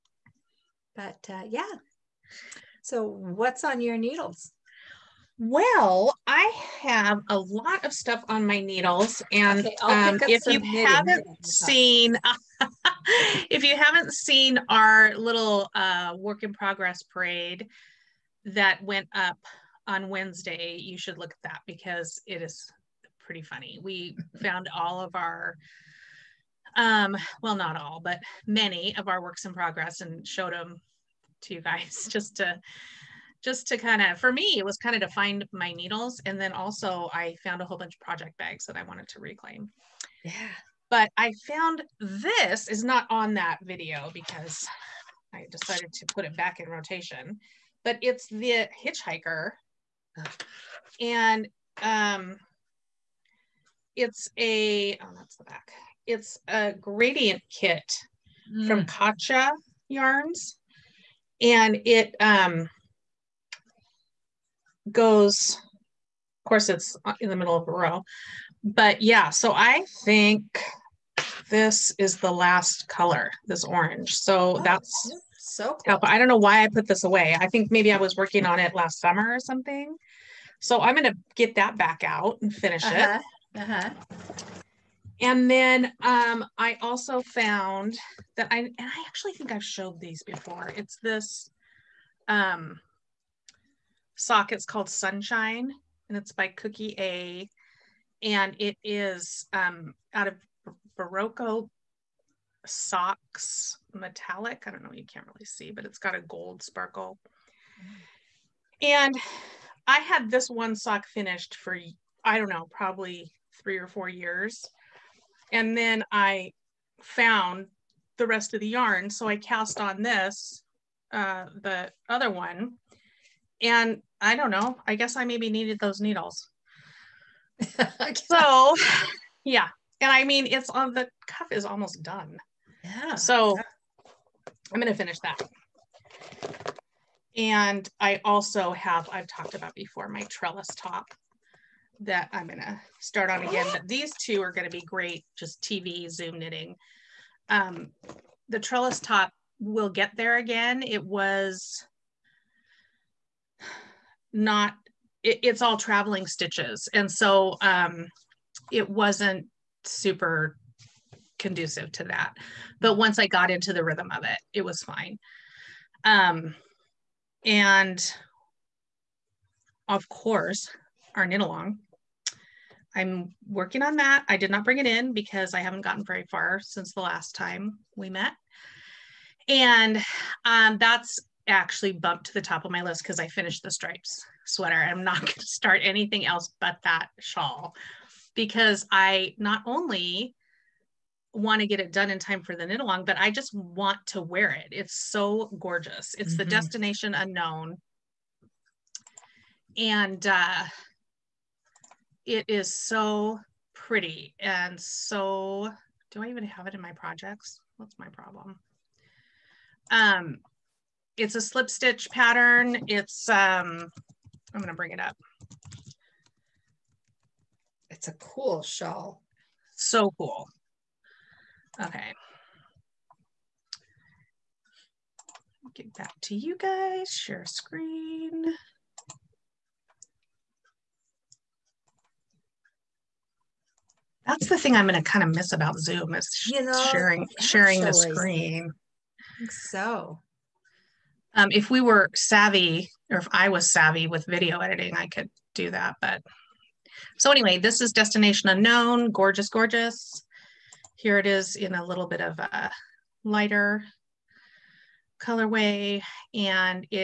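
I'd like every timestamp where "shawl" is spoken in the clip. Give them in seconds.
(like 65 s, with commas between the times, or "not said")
187 s, 218 s.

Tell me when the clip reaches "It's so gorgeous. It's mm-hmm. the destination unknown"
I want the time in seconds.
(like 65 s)
194 s.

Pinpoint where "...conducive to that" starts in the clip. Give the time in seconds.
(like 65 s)
161 s.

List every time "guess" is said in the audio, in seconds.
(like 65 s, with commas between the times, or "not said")
124 s.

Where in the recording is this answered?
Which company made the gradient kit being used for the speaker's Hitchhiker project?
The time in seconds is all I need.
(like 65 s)
58 s.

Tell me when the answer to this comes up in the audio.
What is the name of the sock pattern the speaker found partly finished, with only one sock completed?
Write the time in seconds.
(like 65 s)
94 s.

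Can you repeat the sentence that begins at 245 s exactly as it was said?
But so anyway, this is Destination Unknown.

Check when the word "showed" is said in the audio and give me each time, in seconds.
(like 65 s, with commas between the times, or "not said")
30 s, 89 s.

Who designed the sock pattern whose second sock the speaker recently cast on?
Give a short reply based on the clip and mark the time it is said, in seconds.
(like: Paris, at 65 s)
Cookie A, at 96 s.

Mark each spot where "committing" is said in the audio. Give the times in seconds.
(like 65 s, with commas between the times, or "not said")
not said.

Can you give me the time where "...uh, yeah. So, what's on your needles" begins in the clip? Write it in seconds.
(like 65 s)
1 s.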